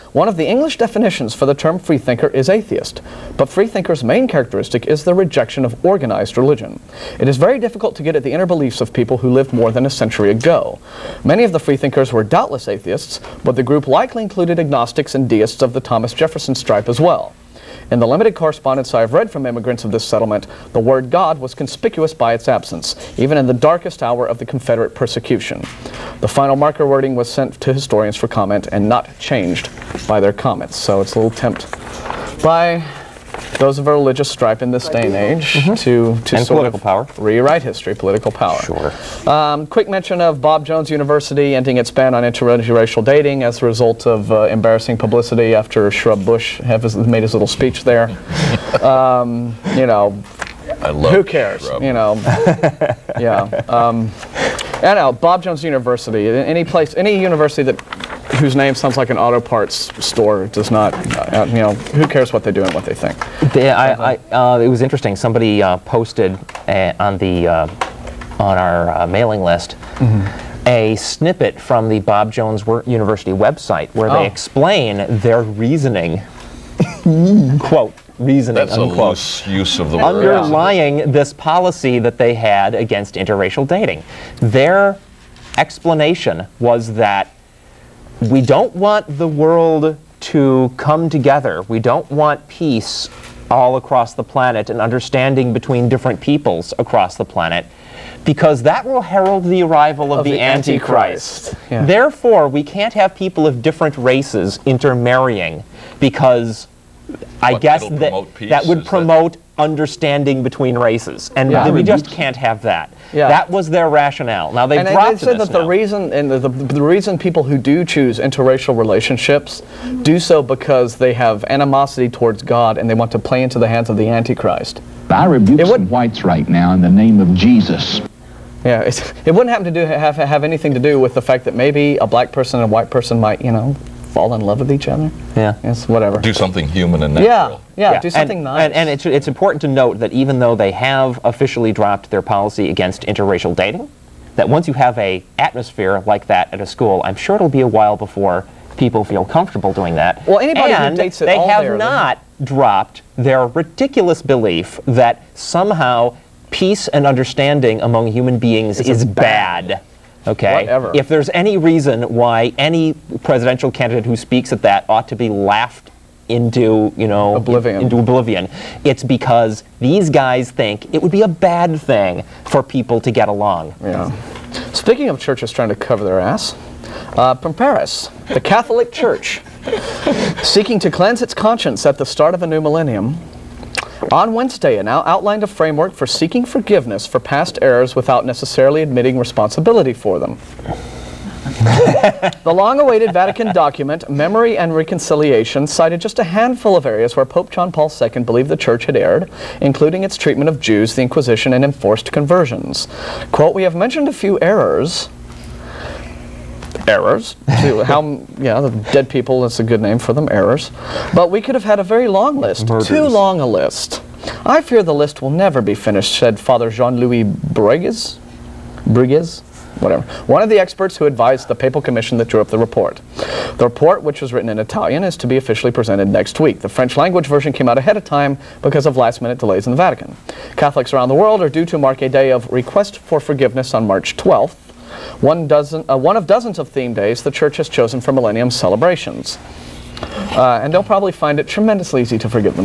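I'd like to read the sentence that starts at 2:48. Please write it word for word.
It's because these guys think it would be a bad thing for people to get along.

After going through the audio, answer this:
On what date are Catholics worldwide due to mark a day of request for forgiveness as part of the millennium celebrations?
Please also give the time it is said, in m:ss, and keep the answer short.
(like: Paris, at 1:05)
March 12th, at 3:53.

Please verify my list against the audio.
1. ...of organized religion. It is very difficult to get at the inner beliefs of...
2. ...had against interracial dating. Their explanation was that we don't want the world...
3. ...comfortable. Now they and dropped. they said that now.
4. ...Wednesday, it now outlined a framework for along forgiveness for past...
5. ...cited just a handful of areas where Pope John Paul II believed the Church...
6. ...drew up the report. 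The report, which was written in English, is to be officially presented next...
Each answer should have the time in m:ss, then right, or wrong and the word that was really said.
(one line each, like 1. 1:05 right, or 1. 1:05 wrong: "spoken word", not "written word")
1. 0:05 right
2. 1:22 right
3. 1:53 wrong: "rationale", not "comfortable"
4. 3:04 wrong: "seeking", not "along"
5. 3:15 right
6. 3:42 wrong: "Italian", not "English".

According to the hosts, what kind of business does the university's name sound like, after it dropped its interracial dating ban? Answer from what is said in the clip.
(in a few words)
auto parts store.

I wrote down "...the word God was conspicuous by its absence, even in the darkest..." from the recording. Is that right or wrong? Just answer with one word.
right.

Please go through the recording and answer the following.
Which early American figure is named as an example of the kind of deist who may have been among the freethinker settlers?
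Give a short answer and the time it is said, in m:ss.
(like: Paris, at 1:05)
Thomas Jefferson, at 0:15.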